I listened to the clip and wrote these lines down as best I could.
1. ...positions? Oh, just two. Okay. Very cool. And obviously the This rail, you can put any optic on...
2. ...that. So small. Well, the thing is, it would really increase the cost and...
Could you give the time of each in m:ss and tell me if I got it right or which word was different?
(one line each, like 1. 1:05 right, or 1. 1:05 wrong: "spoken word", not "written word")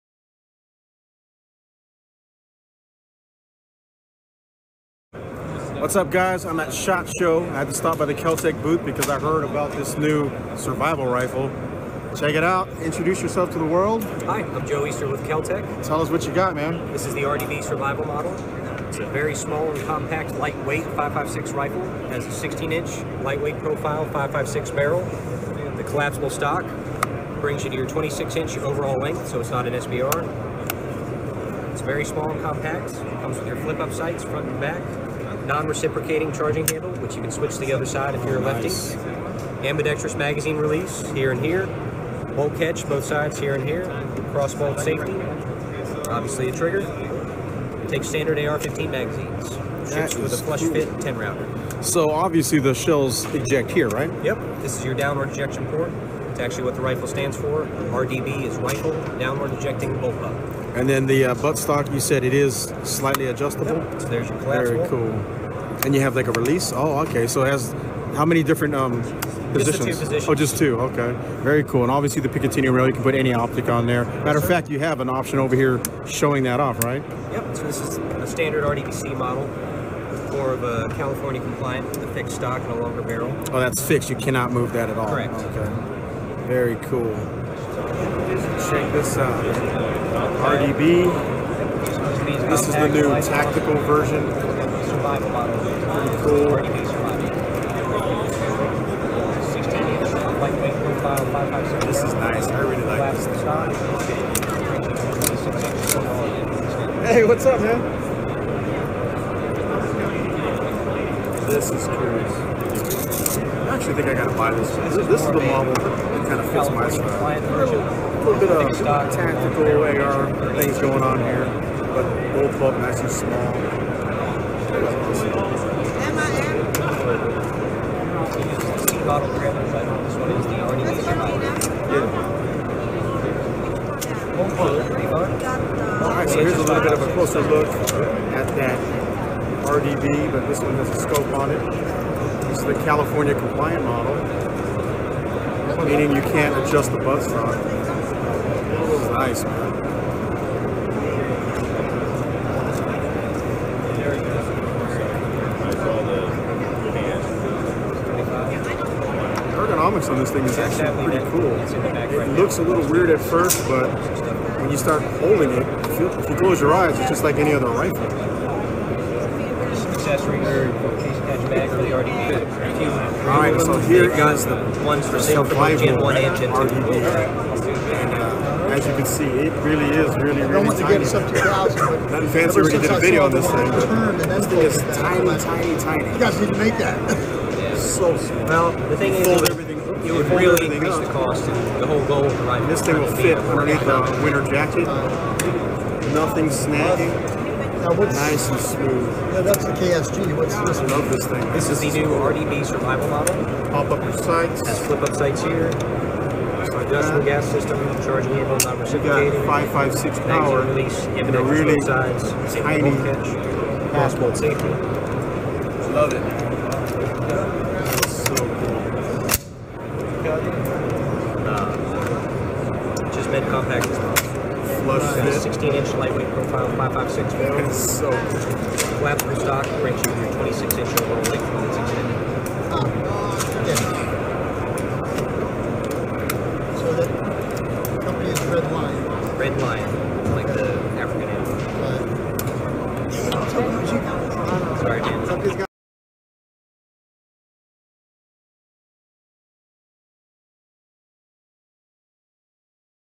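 1. 1:10 wrong: "Picatinny", not "This"
2. 3:06 right.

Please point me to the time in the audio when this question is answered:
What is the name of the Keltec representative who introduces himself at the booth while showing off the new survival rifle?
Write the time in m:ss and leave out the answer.
0:14.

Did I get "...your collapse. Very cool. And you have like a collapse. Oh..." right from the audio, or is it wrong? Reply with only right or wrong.
wrong.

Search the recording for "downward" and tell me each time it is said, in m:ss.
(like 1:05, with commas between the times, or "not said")
0:54, 0:59.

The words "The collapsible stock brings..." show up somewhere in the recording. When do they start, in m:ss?
0:25.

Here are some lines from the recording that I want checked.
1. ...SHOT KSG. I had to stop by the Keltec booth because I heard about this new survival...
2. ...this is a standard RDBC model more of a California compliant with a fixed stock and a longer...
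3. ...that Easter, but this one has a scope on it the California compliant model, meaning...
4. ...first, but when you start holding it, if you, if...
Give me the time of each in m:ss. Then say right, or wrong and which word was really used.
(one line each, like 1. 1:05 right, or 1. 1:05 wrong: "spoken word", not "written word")
1. 0:06 wrong: "Show", not "KSG"
2. 1:17 right
3. 2:18 wrong: "RDB", not "Easter"
4. 2:43 right.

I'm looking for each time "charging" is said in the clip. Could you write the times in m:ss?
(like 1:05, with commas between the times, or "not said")
0:36, 3:28.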